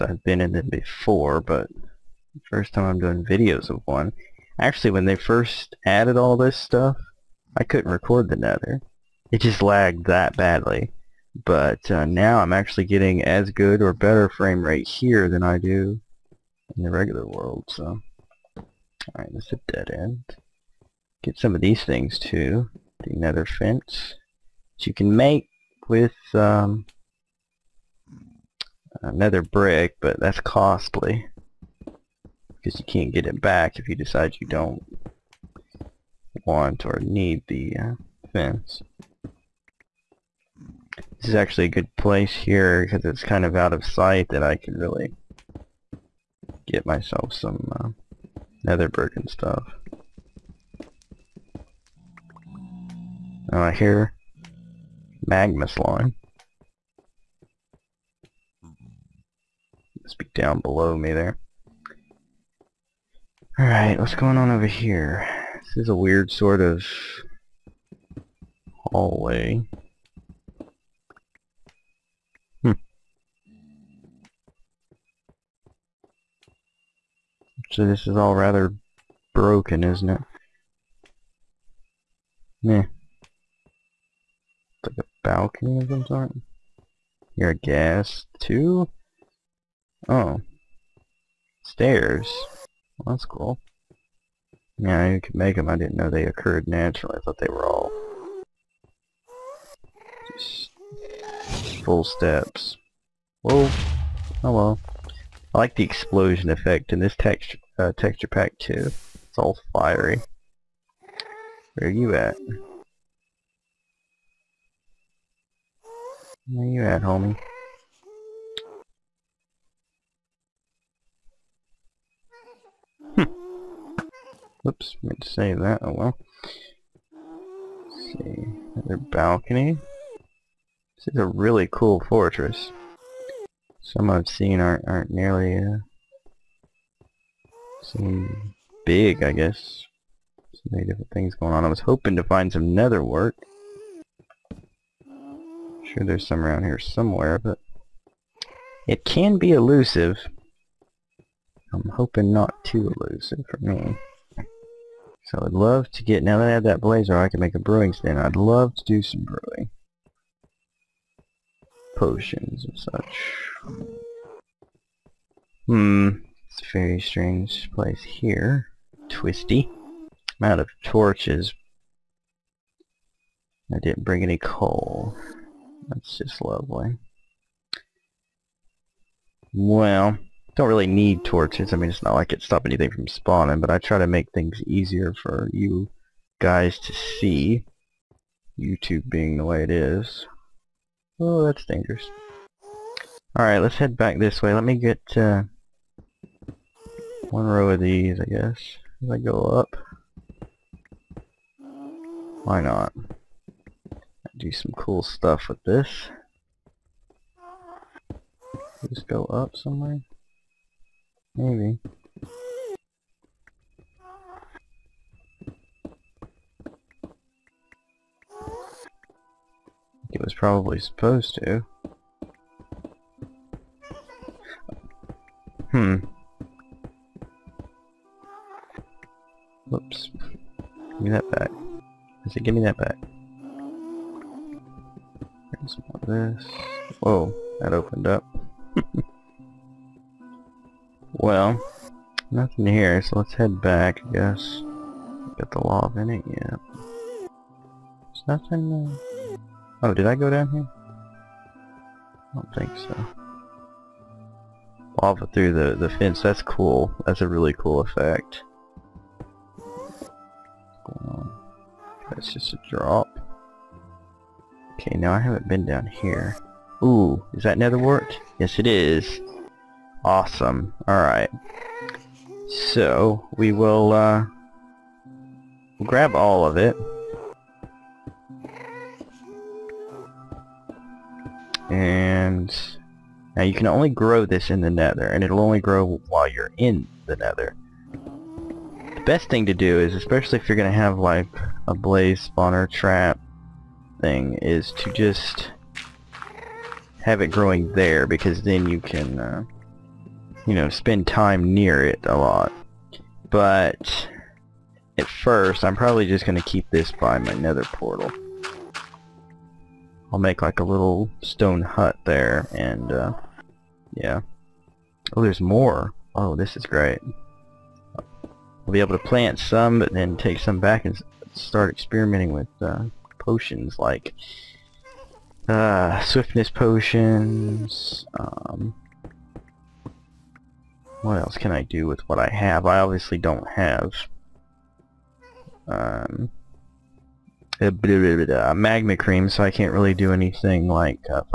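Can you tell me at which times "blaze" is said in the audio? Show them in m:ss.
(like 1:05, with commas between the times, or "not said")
2:36, 4:51.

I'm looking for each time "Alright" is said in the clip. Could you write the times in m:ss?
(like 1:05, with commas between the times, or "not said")
0:18, 1:03, 3:13, 4:30.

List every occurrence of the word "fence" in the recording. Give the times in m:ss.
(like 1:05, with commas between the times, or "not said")
0:23, 0:38, 4:15.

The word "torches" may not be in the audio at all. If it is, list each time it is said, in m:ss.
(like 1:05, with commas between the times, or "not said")
2:50, 3:01.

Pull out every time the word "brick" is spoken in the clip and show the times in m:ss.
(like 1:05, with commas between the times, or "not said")
0:29, 0:48.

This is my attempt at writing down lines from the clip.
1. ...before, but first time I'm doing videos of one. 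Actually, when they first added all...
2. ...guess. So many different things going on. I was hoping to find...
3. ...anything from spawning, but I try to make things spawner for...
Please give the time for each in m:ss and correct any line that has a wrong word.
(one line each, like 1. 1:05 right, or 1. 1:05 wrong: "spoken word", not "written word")
1. 0:00 right
2. 2:19 right
3. 3:02 wrong: "easier", not "spawner".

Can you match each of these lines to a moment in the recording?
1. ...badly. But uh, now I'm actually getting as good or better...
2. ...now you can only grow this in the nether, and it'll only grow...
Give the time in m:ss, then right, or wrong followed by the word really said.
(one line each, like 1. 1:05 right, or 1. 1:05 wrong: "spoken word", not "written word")
1. 0:10 right
2. 4:43 right.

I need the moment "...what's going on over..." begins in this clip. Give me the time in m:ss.
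1:03.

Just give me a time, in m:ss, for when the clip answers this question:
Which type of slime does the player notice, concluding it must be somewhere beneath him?
0:55.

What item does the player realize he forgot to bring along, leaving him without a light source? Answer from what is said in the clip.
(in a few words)
Coal.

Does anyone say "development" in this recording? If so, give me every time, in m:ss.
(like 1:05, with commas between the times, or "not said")
not said.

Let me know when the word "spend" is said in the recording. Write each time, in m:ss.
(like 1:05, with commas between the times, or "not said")
5:00.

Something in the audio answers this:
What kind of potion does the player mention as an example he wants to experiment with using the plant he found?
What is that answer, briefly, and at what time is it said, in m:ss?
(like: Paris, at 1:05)
Swiftness potions, at 5:25.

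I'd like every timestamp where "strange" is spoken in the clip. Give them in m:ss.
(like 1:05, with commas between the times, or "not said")
2:46.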